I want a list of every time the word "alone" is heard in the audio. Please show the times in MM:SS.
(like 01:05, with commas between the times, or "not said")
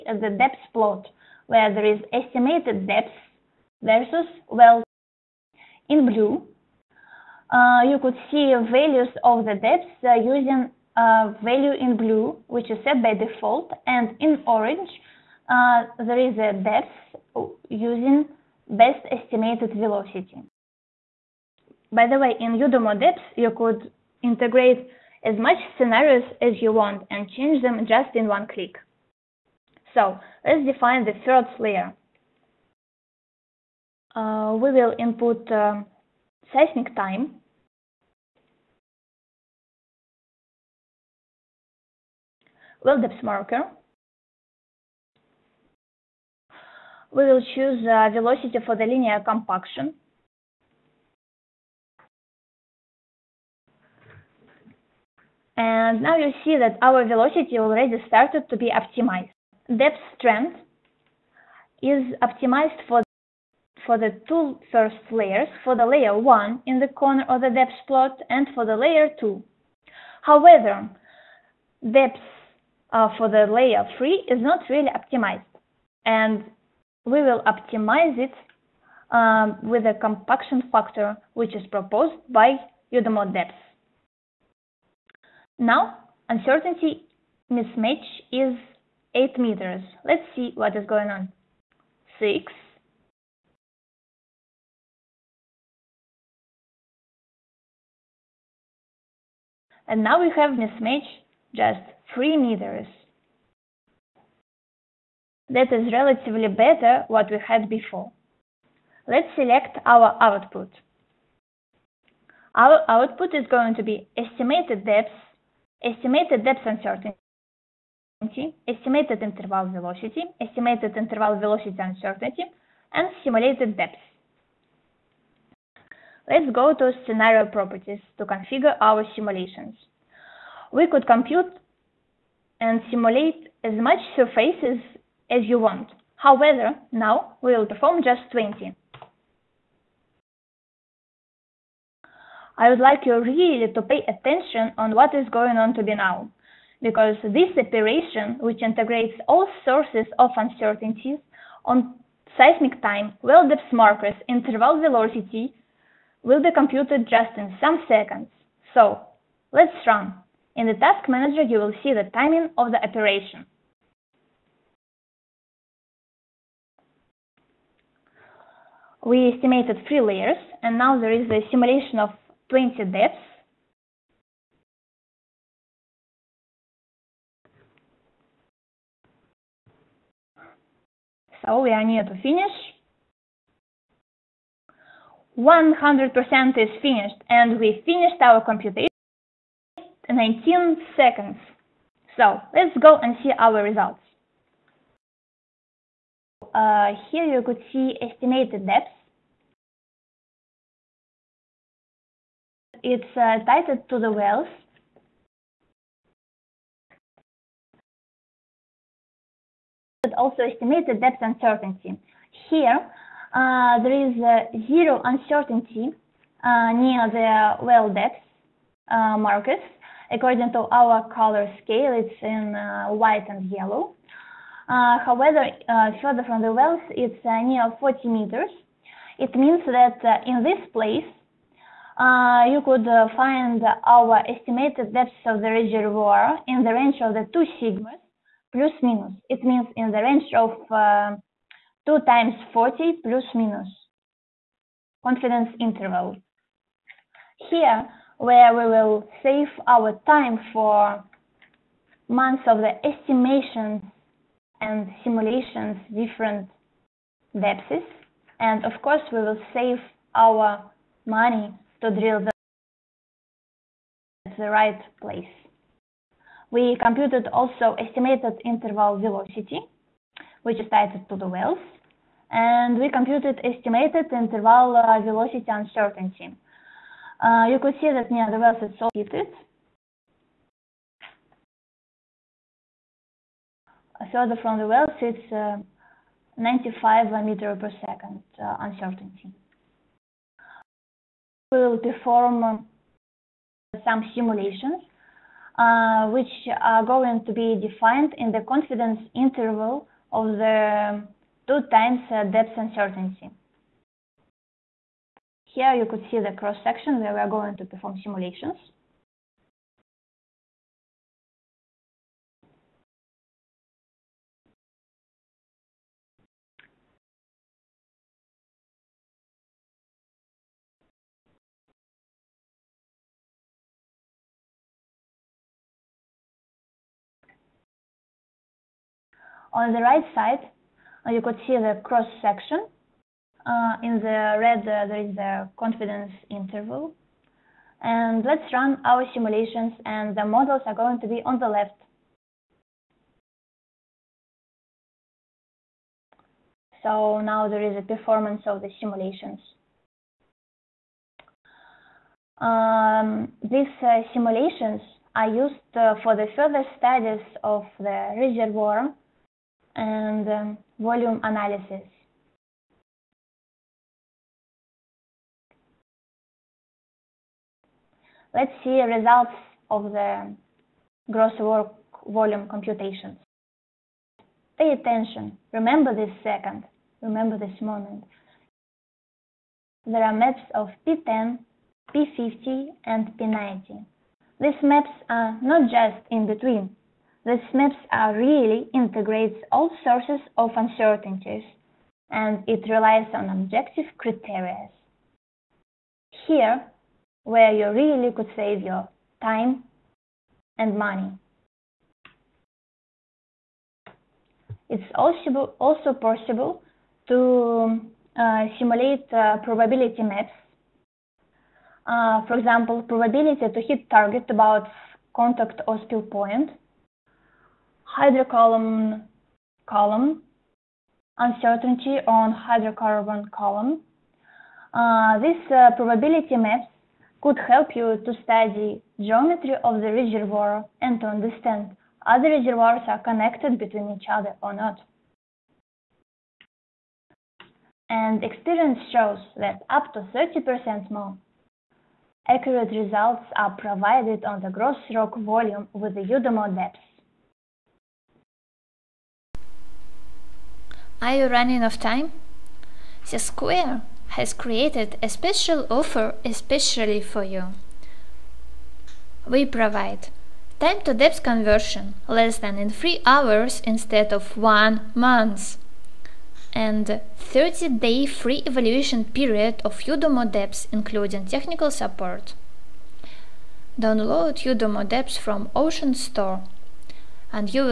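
not said.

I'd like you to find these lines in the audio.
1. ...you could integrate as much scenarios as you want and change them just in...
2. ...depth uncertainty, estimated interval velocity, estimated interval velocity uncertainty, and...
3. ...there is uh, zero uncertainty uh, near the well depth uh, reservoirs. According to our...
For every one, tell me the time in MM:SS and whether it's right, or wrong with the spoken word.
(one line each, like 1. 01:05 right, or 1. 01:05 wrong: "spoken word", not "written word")
1. 00:23 right
2. 01:56 right
3. 03:33 wrong: "markers", not "reservoirs".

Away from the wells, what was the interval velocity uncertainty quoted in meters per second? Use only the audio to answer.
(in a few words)
95.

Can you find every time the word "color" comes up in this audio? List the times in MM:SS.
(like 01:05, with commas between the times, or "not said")
03:41.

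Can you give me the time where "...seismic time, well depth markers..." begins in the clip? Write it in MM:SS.
02:32.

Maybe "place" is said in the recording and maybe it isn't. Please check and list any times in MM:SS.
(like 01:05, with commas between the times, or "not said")
03:50, 04:25.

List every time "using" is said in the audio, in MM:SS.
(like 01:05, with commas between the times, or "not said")
00:10, 00:17.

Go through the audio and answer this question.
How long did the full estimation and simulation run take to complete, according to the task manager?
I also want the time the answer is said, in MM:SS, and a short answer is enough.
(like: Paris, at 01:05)
19 seconds, at 03:10.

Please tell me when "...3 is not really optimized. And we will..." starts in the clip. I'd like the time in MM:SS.
01:13.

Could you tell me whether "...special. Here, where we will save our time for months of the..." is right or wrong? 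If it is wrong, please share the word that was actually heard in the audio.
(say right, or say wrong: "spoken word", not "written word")
wrong: "interval", not "special".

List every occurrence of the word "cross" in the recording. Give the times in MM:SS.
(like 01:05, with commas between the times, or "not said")
05:06, 05:31.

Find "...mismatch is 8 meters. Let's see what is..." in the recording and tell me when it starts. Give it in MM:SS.
01:27.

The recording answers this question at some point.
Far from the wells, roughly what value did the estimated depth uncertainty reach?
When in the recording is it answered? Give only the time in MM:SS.
03:47.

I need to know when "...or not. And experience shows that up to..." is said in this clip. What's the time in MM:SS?
07:14.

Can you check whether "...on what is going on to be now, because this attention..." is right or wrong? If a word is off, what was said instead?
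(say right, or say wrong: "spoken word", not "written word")
wrong: "operation", not "attention".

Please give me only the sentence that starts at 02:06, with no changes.
Let's go to scenario properties to configure our simulations.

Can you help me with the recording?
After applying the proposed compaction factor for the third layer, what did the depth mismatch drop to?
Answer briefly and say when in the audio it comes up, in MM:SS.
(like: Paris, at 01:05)
3 meters, at 01:42.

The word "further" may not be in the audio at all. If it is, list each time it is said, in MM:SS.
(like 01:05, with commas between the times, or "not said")
03:46, 04:44, 05:56.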